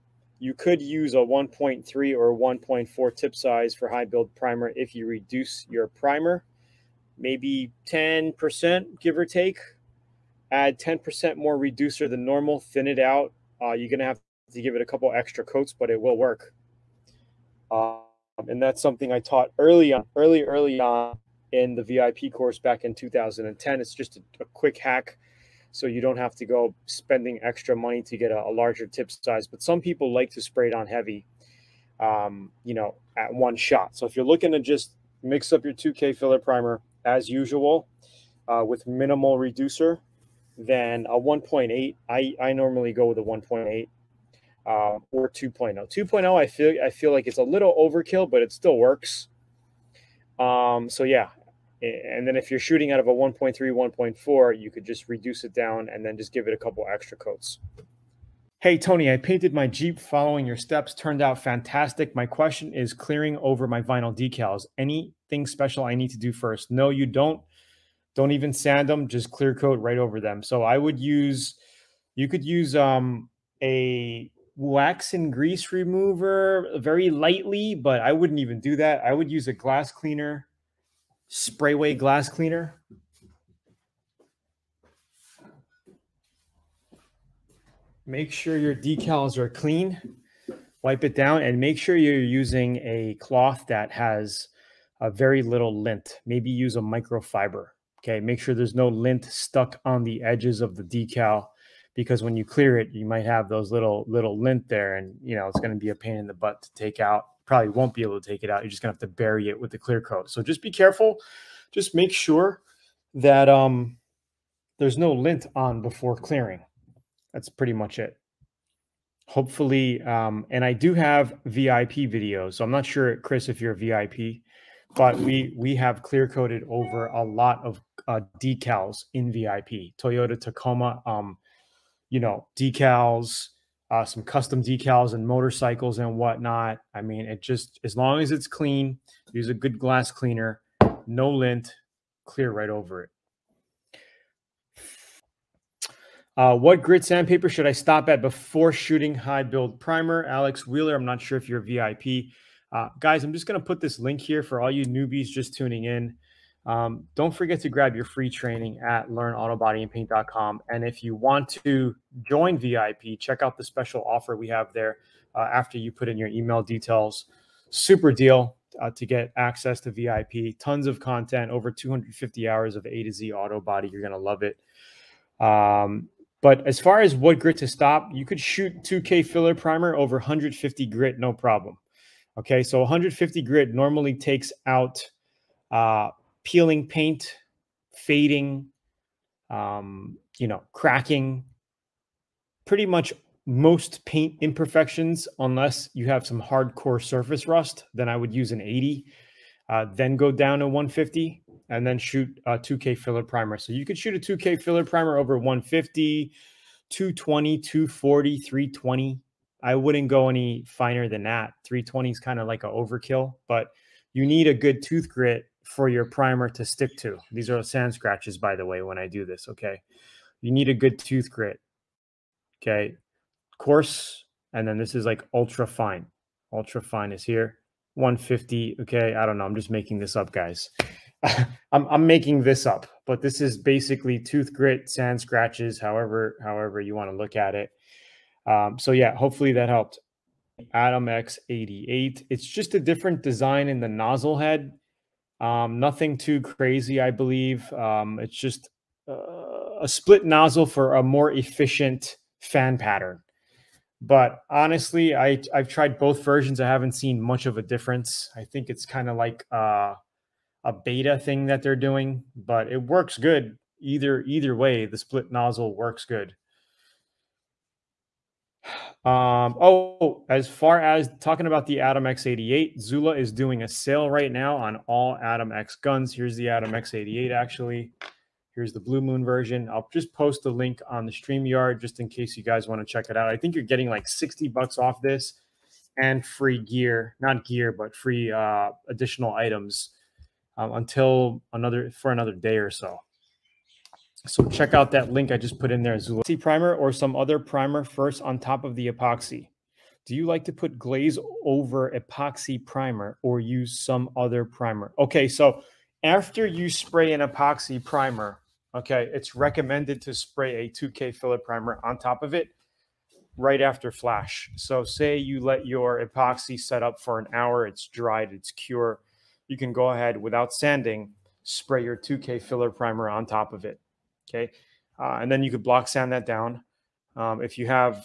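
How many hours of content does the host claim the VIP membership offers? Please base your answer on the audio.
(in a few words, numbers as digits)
over 250 hours.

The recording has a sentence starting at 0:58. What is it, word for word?
Hey Tony, I painted my Jeep following your steps.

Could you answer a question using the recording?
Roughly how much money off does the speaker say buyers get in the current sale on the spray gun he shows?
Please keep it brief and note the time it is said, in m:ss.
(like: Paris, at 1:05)
60 bucks, at 4:44.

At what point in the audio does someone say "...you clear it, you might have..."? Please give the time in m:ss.
1:42.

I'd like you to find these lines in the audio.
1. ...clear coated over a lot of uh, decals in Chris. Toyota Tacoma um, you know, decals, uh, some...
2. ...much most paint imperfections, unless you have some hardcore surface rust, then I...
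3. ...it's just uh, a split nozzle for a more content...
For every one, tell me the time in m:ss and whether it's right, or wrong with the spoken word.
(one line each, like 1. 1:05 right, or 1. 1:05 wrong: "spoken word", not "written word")
1. 2:06 wrong: "VIP", not "Chris"
2. 3:12 right
3. 4:08 wrong: "efficient", not "content".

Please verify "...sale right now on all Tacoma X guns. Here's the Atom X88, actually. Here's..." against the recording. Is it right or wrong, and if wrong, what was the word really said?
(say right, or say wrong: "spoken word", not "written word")
wrong: "Atom", not "Tacoma".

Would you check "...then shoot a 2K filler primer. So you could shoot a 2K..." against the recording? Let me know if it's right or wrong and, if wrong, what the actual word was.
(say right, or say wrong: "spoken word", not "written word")
right.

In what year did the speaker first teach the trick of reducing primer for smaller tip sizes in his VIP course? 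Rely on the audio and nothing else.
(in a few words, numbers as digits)
2010.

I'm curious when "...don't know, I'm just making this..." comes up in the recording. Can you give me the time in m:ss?
3:49.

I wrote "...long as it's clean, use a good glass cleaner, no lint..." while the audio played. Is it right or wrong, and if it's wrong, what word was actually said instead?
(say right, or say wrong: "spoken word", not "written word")
right.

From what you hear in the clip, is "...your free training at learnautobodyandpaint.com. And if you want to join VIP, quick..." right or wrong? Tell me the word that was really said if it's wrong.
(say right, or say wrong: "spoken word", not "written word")
wrong: "check", not "quick".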